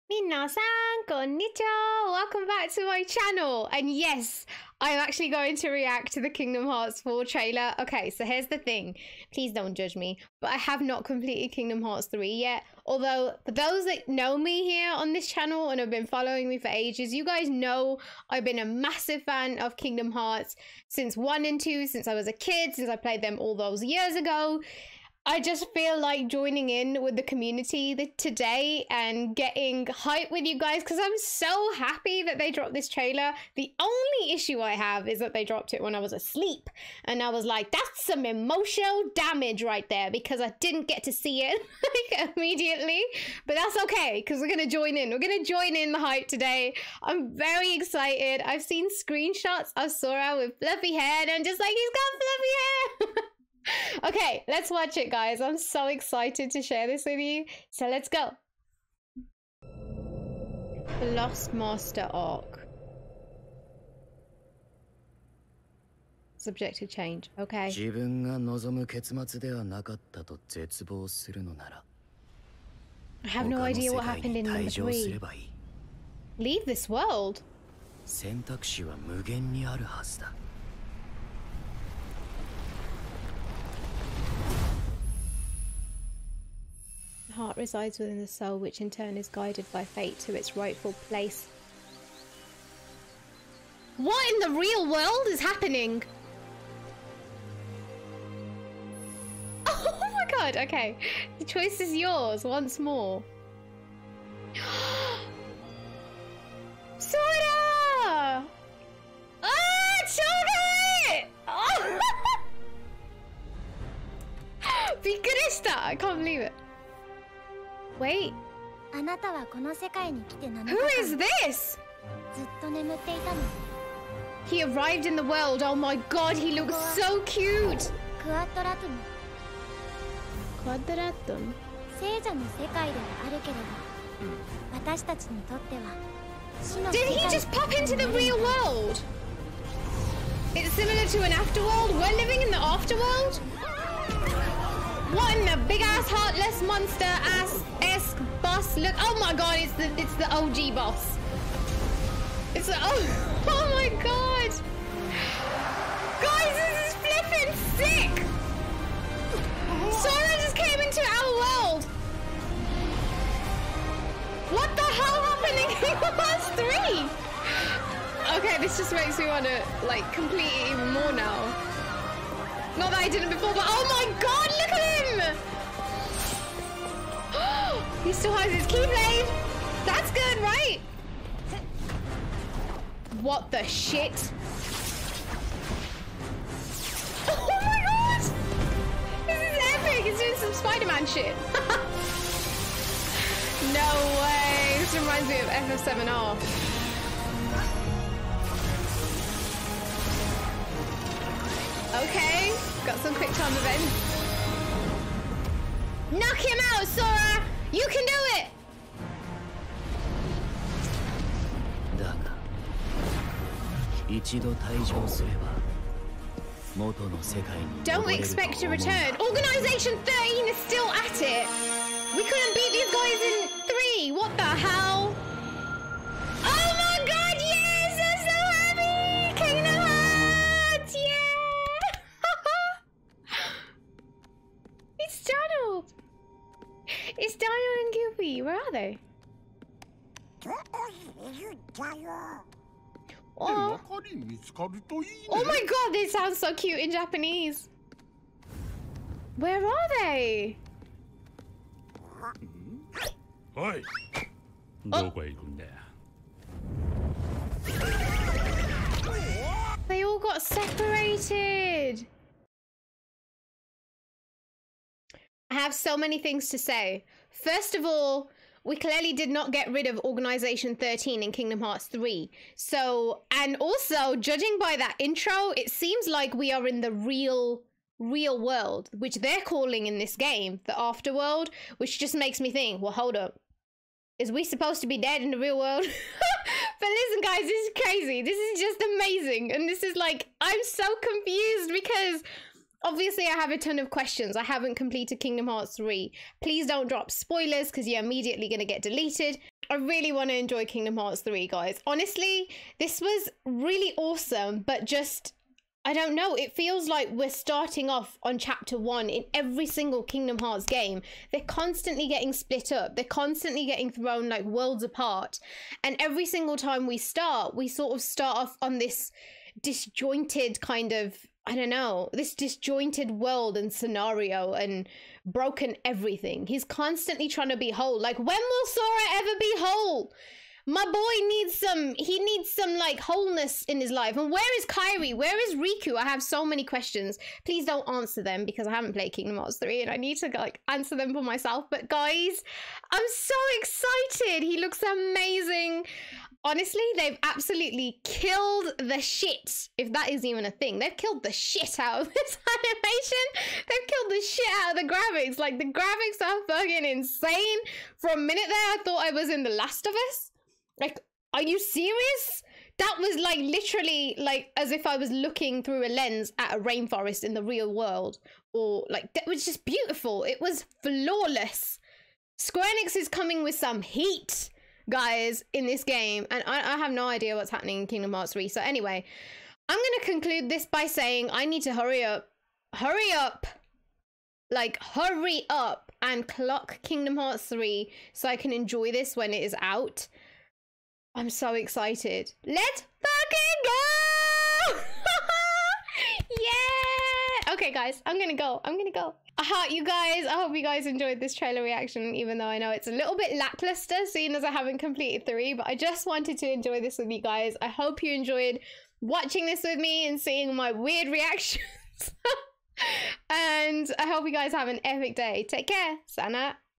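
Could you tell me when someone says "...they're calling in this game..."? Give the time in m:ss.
4:39.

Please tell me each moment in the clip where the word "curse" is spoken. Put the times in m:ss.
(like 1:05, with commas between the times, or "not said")
not said.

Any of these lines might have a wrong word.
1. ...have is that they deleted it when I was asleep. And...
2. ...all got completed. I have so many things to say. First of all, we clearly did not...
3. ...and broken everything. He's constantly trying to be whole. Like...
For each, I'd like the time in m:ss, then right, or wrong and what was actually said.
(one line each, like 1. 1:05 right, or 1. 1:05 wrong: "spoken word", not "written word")
1. 0:34 wrong: "dropped", not "deleted"
2. 4:20 wrong: "separated", not "completed"
3. 5:24 right.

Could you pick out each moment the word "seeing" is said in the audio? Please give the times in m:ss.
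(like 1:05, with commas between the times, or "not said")
6:44, 6:50.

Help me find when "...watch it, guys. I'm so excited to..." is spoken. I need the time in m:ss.
0:54.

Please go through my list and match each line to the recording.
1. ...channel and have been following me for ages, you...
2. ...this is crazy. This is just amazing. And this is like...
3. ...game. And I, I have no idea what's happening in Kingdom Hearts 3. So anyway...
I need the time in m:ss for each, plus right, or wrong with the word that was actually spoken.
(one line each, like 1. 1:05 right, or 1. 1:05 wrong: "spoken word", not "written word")
1. 0:15 right
2. 4:47 right
3. 6:15 right.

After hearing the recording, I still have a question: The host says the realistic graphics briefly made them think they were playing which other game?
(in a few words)
The Last of Us.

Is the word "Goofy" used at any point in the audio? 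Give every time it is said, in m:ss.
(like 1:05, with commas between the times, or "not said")
3:58.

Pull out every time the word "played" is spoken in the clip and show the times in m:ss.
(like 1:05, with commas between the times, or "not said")
0:22, 5:38.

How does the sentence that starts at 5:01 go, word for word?
Honestly, this was really awesome, but just I don't know.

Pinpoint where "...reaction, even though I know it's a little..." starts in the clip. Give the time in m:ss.
6:41.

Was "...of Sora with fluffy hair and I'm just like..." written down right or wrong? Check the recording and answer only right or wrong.
right.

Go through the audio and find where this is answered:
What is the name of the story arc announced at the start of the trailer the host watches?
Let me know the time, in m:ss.
1:01.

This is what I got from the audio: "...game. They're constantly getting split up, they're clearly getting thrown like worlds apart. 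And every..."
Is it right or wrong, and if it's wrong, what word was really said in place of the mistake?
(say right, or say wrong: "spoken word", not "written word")
wrong: "constantly", not "clearly".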